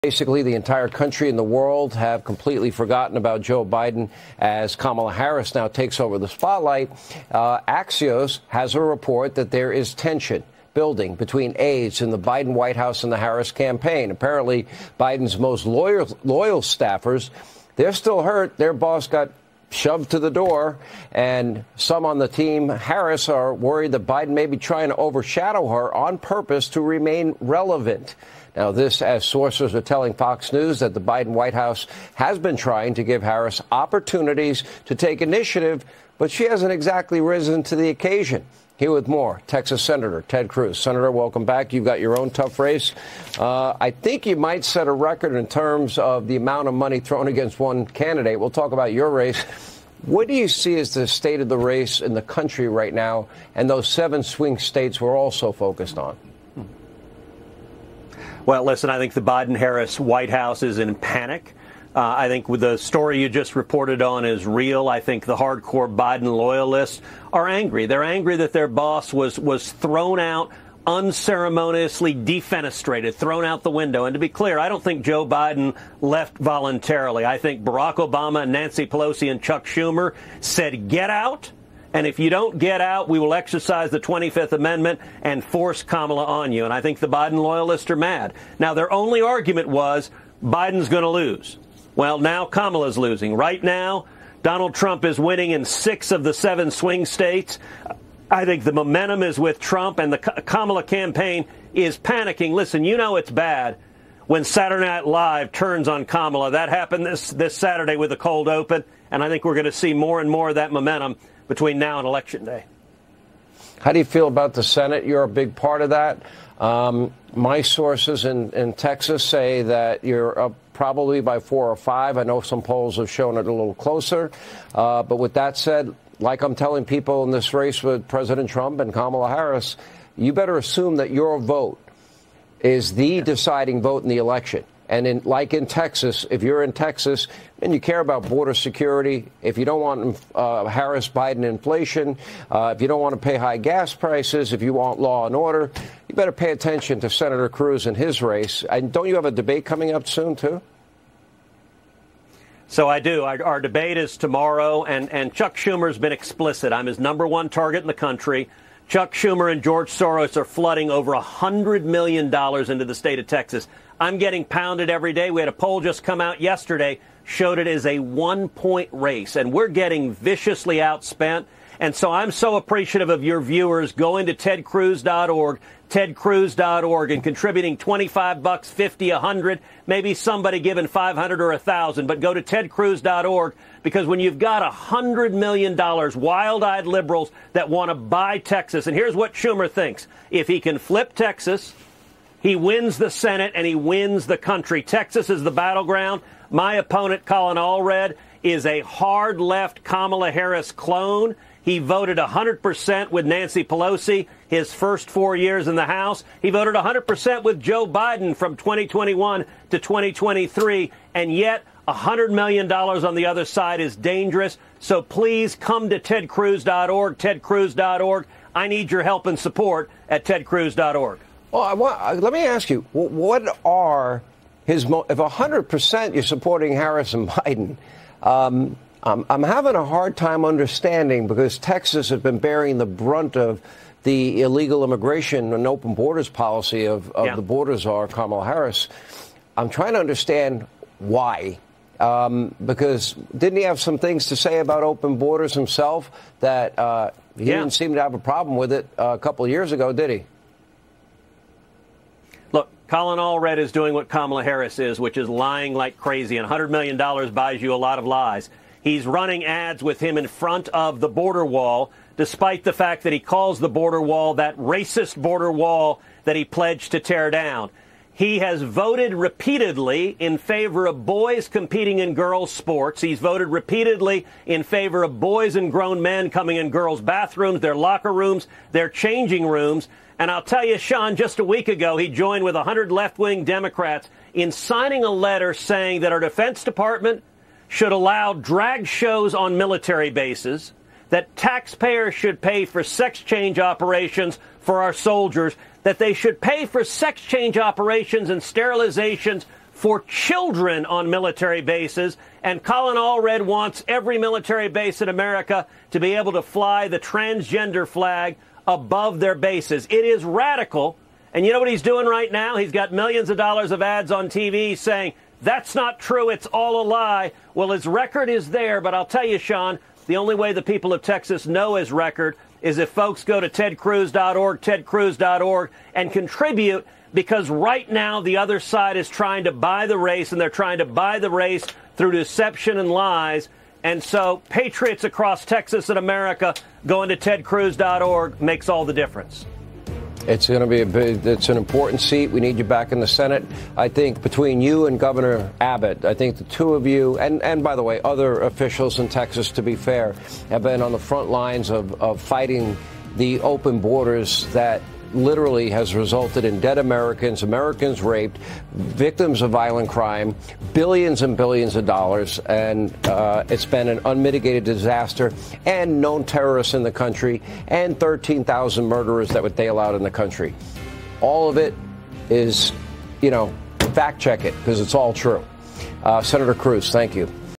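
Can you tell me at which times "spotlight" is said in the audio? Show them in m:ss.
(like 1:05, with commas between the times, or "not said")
0:06.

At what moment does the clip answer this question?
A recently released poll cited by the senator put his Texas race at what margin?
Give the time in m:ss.
2:47.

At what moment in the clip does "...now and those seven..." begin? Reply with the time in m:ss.
0:52.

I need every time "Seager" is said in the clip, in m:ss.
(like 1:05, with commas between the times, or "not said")
not said.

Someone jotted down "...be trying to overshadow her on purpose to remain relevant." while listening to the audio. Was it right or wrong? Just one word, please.
right.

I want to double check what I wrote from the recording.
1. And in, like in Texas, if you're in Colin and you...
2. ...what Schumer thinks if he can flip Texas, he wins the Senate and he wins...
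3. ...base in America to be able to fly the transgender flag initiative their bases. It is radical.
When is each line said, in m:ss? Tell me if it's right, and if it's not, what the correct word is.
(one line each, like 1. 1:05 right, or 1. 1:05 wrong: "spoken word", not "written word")
1. 2:14 wrong: "Texas", not "Colin"
2. 3:09 right
3. 5:04 wrong: "above", not "initiative".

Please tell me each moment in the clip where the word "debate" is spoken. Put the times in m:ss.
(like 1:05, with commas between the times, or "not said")
2:29, 2:33.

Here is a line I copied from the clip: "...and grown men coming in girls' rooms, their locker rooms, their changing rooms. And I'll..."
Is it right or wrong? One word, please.
wrong.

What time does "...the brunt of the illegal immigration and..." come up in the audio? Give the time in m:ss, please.
3:52.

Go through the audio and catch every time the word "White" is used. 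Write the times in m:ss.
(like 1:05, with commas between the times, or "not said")
0:12, 0:31, 0:59.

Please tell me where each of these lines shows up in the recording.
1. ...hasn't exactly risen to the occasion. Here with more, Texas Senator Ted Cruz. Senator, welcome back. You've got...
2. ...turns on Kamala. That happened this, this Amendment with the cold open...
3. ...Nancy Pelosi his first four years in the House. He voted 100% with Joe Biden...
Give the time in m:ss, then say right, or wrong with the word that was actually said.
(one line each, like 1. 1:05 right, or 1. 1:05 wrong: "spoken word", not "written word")
1. 0:36 right
2. 1:45 wrong: "Saturday", not "Amendment"
3. 3:23 right.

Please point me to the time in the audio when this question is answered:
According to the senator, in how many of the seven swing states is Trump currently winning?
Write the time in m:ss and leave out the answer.
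1:35.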